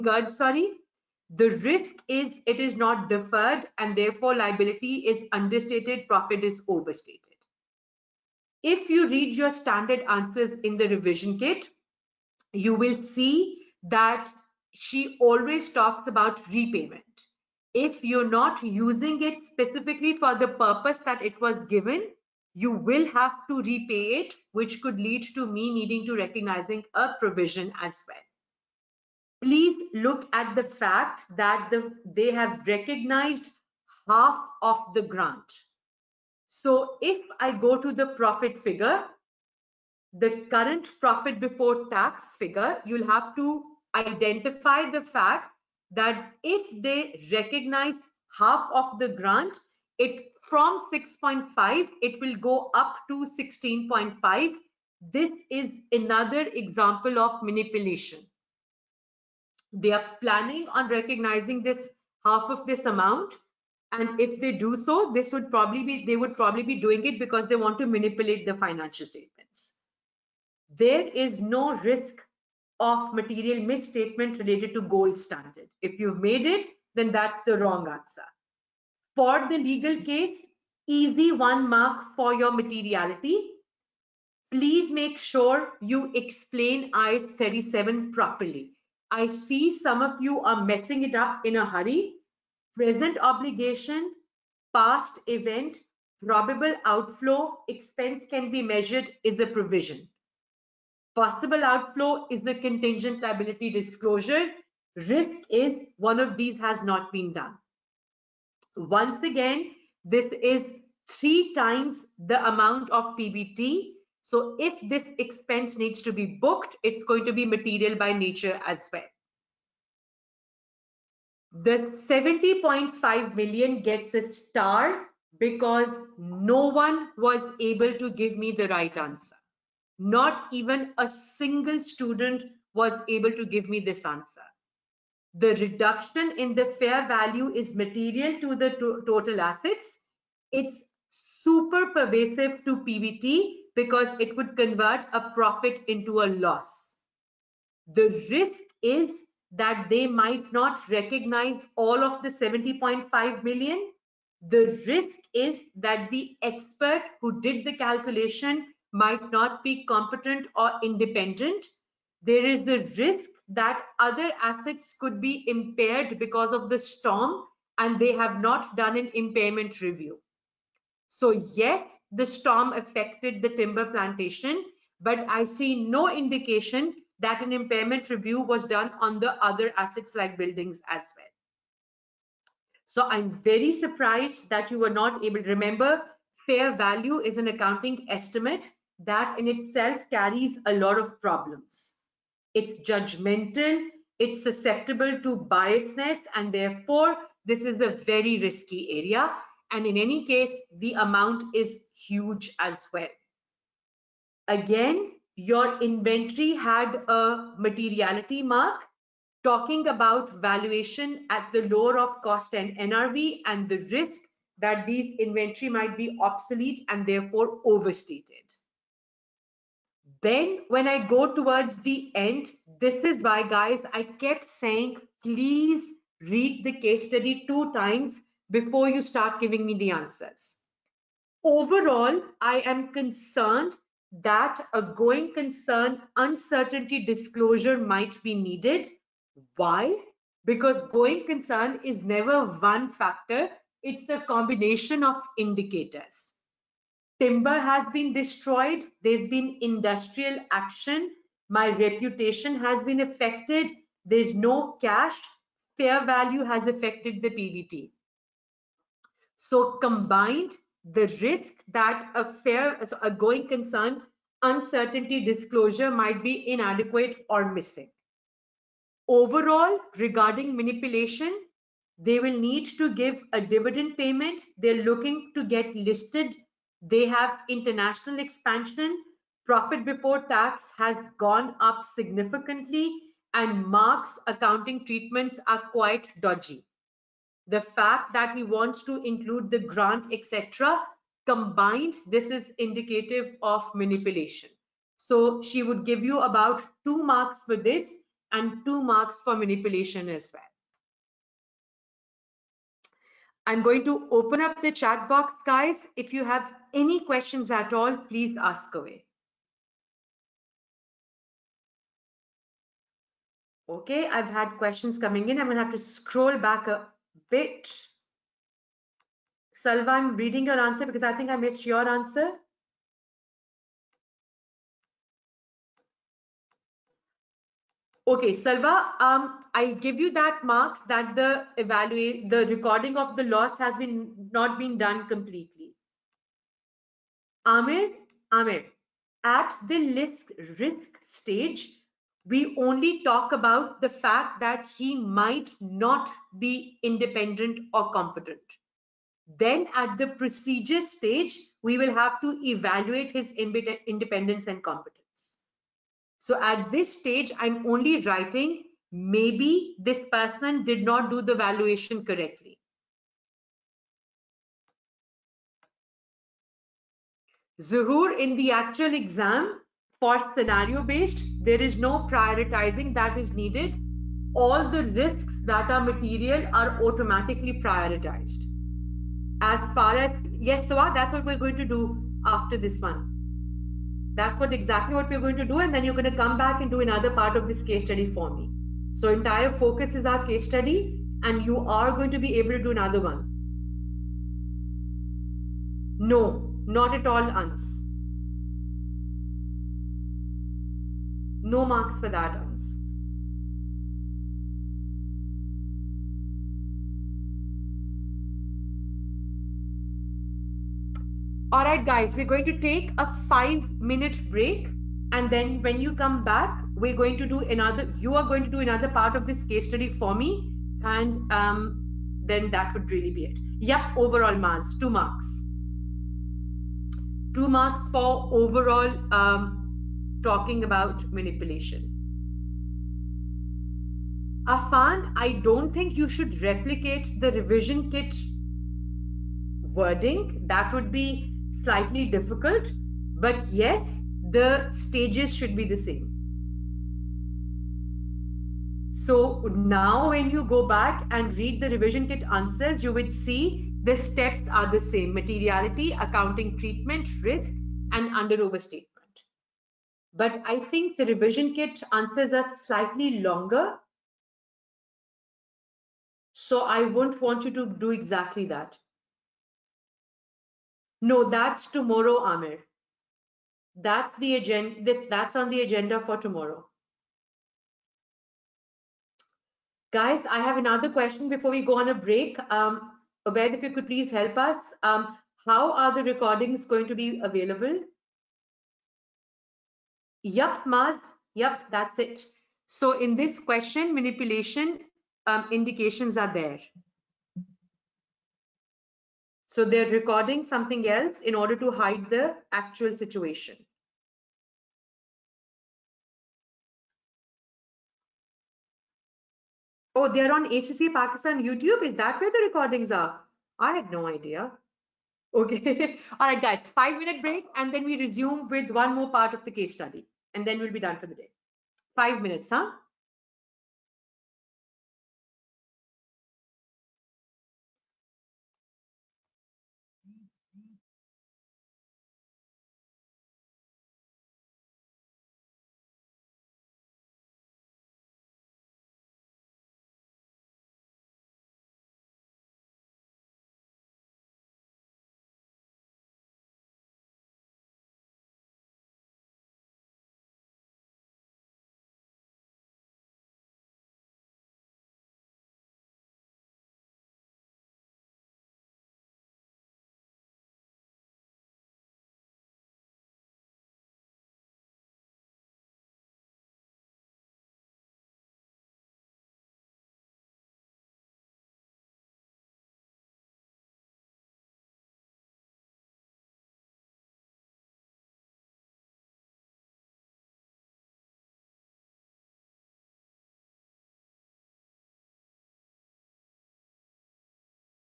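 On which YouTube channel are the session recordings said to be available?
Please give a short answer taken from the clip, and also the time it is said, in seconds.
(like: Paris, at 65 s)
ACCA Pakistan, at 510 s.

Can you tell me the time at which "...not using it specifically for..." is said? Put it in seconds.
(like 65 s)
18 s.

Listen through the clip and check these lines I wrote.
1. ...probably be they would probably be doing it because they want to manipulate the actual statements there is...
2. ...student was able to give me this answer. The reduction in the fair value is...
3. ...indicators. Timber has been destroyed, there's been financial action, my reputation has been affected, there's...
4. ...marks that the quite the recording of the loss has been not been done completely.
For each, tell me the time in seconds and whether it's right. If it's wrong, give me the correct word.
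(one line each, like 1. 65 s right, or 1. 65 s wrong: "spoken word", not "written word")
1. 65 s wrong: "financial", not "actual"
2. 131 s right
3. 245 s wrong: "industrial", not "financial"
4. 330 s wrong: "evaluate", not "quite".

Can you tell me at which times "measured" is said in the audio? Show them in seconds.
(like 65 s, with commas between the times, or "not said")
98 s.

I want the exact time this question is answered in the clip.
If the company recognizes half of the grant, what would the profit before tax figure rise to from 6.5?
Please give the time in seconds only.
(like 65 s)
53 s.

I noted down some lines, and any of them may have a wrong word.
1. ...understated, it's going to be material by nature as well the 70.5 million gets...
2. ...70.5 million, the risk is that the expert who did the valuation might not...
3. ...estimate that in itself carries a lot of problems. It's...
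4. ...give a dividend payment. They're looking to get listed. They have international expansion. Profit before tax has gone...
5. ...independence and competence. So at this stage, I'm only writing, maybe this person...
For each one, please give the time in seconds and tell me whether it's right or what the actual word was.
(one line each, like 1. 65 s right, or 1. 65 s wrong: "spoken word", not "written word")
1. 116 s wrong: "booked", not "understated"
2. 152 s wrong: "calculation", not "valuation"
3. 188 s right
4. 272 s right
5. 353 s right.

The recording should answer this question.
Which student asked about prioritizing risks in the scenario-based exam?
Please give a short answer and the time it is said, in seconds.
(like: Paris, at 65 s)
Zuhur, at 367 s.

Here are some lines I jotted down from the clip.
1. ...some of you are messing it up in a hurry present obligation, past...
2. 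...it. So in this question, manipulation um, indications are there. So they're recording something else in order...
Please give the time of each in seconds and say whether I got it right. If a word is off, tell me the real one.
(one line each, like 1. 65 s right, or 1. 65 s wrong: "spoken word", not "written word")
1. 89 s right
2. 492 s right.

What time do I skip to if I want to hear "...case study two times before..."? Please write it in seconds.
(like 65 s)
226 s.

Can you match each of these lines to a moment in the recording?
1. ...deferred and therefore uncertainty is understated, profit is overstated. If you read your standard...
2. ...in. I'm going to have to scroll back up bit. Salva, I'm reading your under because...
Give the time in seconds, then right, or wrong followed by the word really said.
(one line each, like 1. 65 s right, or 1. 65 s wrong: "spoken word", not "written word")
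1. 3 s wrong: "liability", not "uncertainty"
2. 315 s wrong: "answer", not "under".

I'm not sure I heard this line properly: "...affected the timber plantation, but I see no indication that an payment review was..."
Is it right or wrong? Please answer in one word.
wrong.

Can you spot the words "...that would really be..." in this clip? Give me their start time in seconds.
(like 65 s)
422 s.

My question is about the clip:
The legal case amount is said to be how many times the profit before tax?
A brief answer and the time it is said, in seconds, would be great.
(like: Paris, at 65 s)
three times, at 111 s.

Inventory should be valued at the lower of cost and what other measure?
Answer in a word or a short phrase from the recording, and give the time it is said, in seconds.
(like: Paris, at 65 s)
NRV, at 212 s.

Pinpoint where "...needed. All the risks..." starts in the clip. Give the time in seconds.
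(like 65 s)
373 s.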